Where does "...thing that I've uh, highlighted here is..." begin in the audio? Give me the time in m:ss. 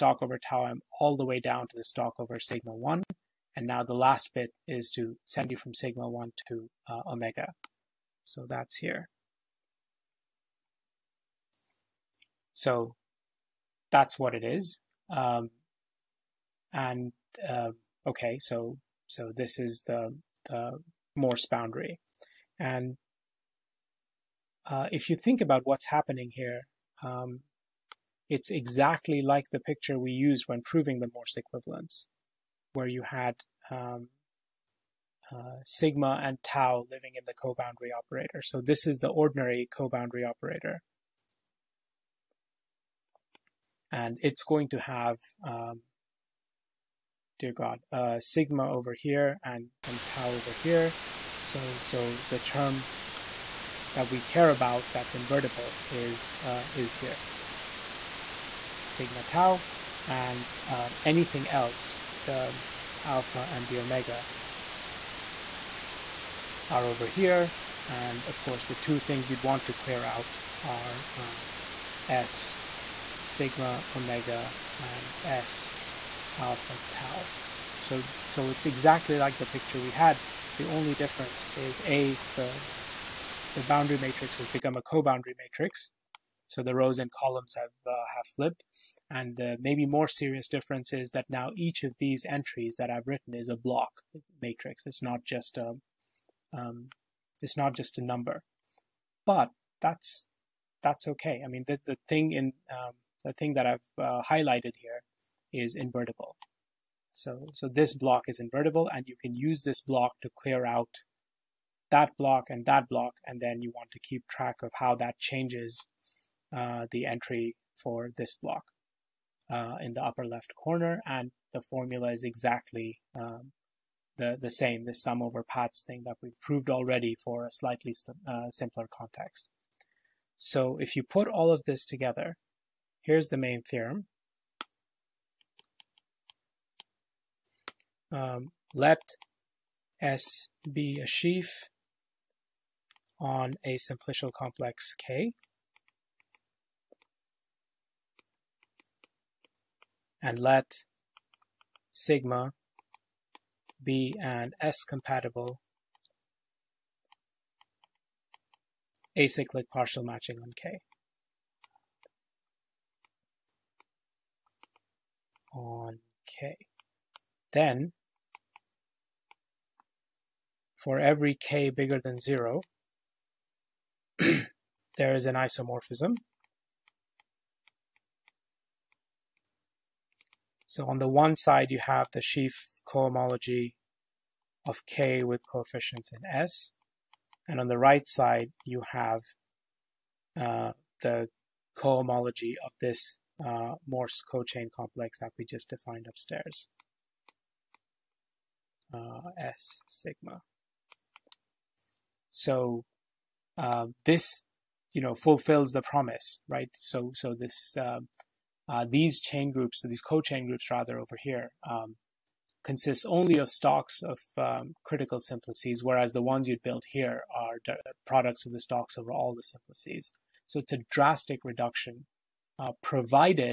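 1:43.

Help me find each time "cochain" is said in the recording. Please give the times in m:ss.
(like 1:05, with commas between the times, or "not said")
3:14.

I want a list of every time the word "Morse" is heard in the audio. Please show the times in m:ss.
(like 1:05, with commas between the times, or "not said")
0:21, 0:31, 3:13.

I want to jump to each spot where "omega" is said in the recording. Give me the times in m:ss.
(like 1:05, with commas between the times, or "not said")
0:07, 1:03, 1:13.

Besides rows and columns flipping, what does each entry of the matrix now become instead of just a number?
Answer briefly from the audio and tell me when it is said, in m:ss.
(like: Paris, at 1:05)
a block matrix, at 1:33.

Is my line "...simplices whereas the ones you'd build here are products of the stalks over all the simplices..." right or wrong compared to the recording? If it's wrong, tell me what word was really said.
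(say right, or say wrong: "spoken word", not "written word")
right.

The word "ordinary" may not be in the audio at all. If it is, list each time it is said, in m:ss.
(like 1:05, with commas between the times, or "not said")
0:39.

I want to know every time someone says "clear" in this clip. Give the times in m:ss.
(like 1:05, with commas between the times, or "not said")
1:09, 1:50.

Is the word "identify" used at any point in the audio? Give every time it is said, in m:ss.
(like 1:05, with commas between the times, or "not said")
not said.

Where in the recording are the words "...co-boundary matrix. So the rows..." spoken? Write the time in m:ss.
1:24.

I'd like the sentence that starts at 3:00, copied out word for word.
So on the one side, you have the sheaf cohomology of K with coefficients in S.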